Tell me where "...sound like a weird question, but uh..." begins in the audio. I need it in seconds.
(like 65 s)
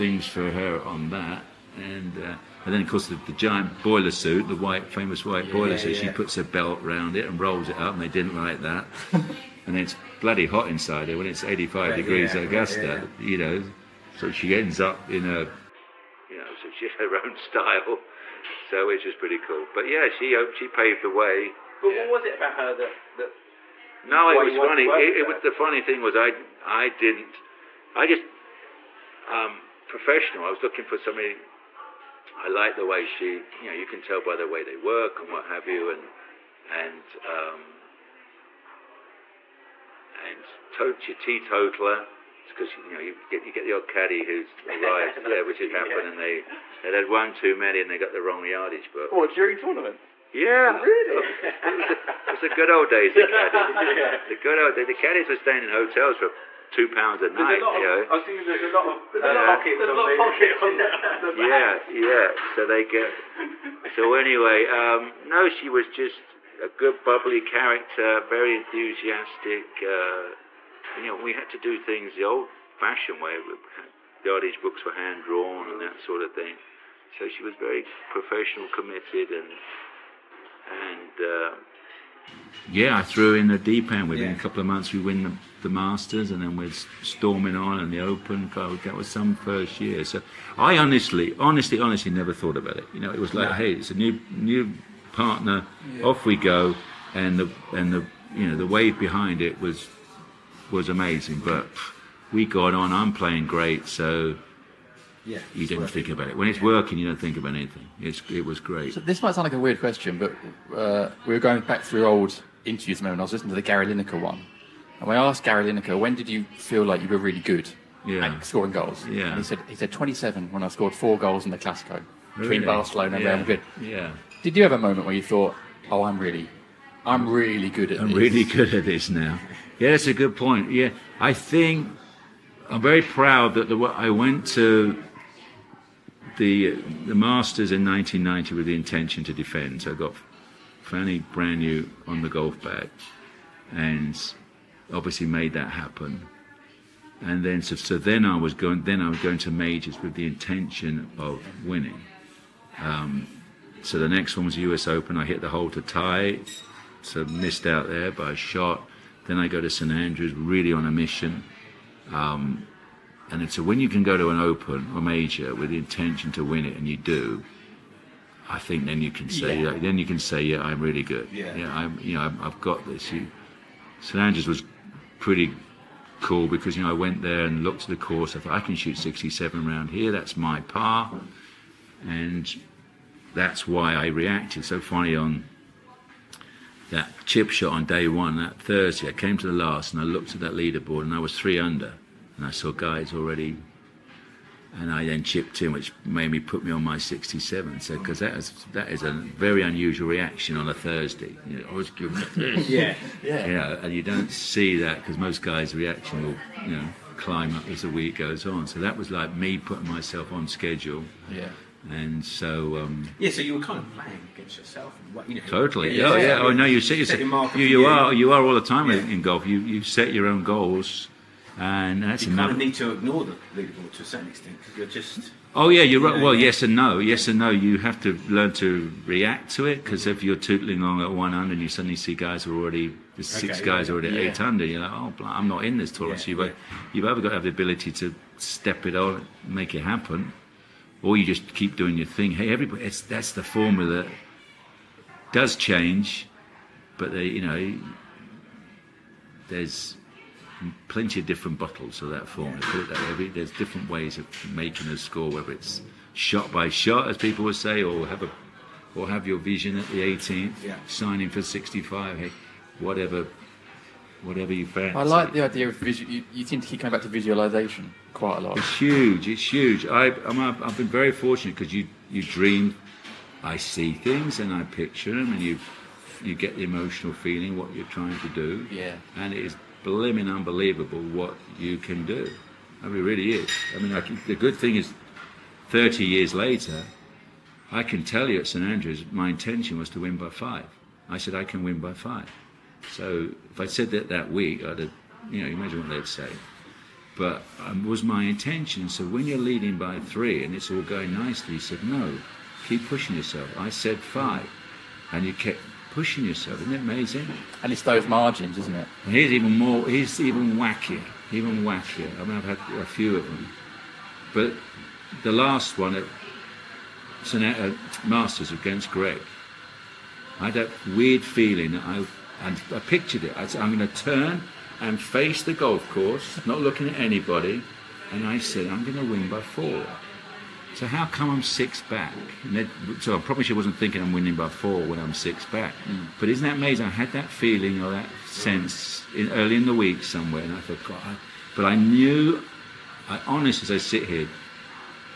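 109 s.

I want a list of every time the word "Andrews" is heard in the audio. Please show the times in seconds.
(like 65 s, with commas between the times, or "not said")
159 s, 174 s, 288 s.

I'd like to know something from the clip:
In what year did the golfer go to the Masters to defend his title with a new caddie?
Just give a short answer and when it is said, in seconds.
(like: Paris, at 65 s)
1990, at 137 s.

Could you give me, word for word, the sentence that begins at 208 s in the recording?
So that was like me putting myself on schedule.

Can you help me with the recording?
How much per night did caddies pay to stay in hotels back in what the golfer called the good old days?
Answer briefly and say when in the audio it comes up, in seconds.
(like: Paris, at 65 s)
two pounds, at 56 s.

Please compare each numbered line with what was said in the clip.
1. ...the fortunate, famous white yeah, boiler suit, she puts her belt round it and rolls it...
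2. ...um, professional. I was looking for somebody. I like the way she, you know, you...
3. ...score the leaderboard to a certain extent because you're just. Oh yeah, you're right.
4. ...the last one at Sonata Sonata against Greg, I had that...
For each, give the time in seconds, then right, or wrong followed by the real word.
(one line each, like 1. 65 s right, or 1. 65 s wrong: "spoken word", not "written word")
1. 4 s wrong: "white", not "fortunate"
2. 29 s right
3. 222 s wrong: "ignore", not "score"
4. 315 s wrong: "Masters", not "Sonata".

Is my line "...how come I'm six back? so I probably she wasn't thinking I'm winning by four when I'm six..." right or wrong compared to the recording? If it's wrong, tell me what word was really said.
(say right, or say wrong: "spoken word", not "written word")
right.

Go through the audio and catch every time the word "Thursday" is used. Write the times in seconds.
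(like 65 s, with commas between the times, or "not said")
188 s, 200 s.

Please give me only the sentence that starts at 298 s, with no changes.
So when you're leading by three and it's all going nicely, he said, no, keep pushing yourself.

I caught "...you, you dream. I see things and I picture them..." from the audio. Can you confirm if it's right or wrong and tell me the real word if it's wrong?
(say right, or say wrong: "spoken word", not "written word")
right.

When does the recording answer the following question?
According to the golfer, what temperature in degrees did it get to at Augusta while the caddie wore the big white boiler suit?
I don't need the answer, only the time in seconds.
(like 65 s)
11 s.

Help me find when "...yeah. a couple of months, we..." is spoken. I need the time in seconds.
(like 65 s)
84 s.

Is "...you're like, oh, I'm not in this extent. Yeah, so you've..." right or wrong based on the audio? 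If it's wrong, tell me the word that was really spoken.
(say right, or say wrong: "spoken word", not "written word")
wrong: "tournament", not "extent".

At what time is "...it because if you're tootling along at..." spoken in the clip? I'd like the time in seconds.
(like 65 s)
229 s.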